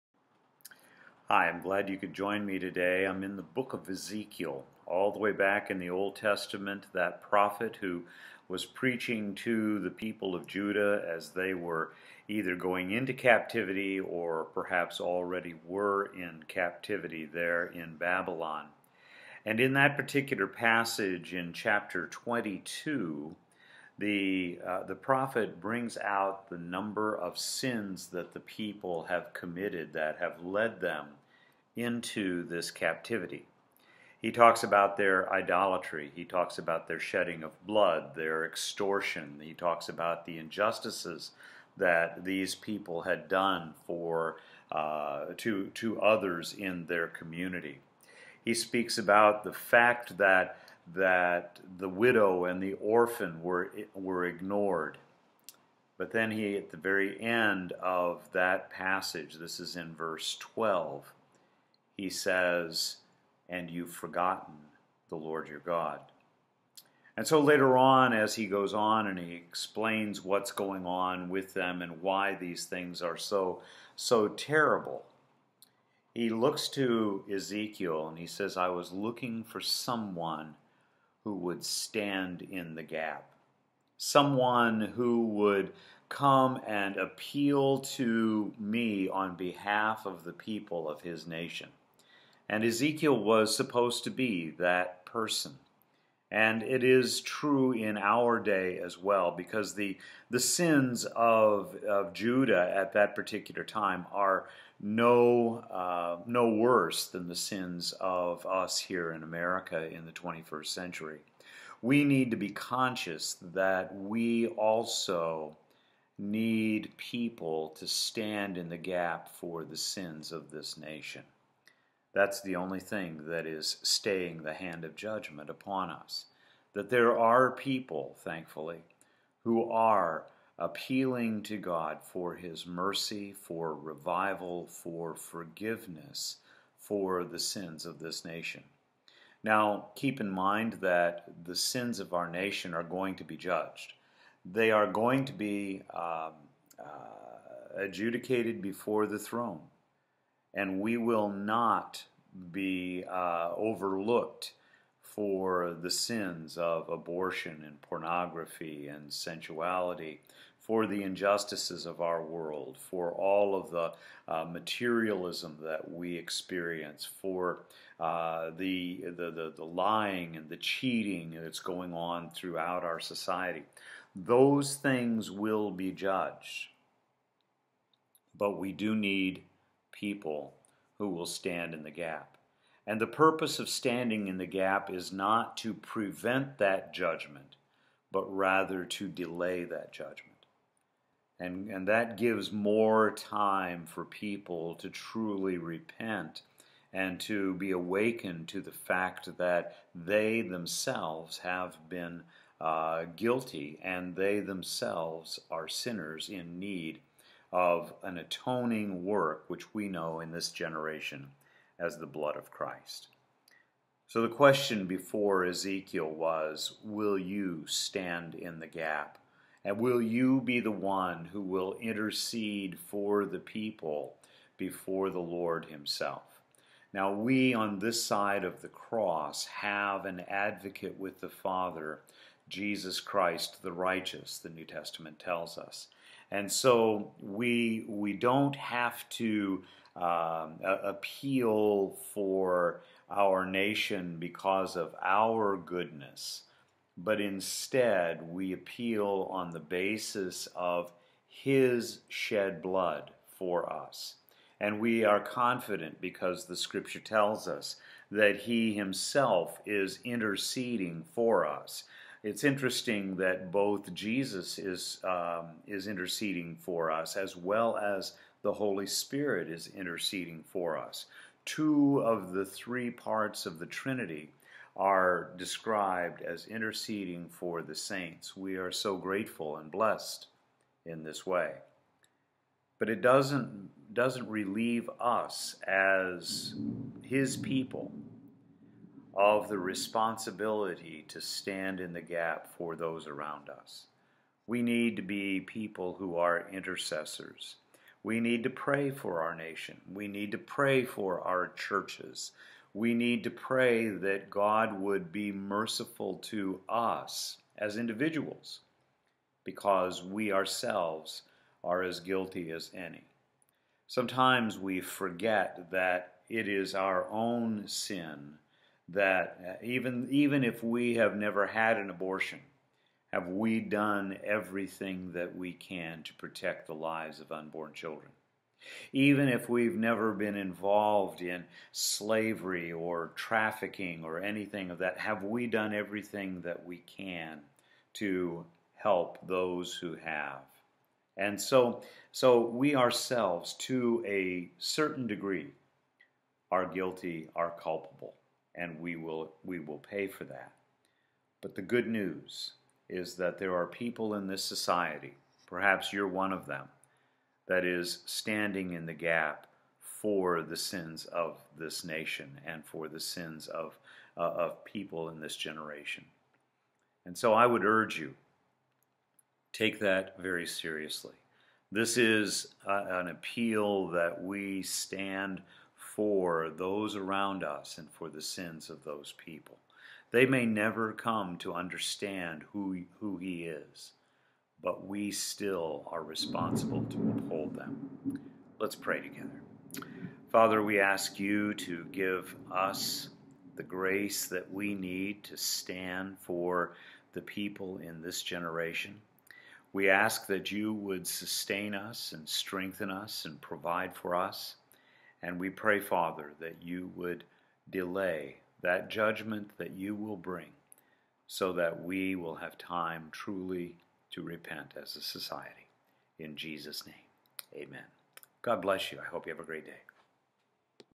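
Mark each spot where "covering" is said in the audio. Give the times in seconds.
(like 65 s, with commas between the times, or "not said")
not said.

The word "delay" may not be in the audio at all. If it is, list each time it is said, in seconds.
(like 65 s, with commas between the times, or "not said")
189 s, 407 s.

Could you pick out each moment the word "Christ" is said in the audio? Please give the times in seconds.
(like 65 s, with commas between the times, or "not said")
212 s, 232 s.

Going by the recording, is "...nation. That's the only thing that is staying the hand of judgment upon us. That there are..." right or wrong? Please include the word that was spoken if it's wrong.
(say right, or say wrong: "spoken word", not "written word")
right.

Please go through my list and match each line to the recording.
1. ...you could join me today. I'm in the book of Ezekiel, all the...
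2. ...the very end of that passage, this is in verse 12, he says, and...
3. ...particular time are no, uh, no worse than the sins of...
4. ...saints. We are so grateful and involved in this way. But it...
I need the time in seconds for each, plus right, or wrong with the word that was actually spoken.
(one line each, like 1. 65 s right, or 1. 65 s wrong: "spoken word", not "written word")
1. 1 s right
2. 56 s right
3. 103 s right
4. 277 s wrong: "blessed", not "involved".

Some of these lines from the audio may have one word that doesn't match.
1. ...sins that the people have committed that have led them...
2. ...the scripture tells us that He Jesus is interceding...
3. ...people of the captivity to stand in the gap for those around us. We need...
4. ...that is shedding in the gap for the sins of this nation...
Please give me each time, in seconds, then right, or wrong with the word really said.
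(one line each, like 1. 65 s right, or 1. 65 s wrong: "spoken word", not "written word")
1. 27 s right
2. 256 s wrong: "Himself", not "Jesus"
3. 287 s wrong: "responsibility", not "captivity"
4. 357 s wrong: "standing", not "shedding".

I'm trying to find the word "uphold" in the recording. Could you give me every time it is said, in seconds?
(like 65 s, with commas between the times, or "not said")
387 s.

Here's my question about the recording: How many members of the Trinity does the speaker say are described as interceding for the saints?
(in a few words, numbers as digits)
2.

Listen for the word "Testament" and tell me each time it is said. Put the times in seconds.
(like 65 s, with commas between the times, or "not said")
6 s, 234 s.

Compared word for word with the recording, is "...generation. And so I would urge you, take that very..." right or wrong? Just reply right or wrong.
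right.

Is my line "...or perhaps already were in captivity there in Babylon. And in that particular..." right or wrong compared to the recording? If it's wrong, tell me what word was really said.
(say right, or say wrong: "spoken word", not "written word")
right.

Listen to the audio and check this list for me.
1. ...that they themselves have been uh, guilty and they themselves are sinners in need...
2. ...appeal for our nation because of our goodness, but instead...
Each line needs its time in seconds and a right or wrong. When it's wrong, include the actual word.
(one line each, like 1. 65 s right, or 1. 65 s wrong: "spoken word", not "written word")
1. 199 s right
2. 240 s right.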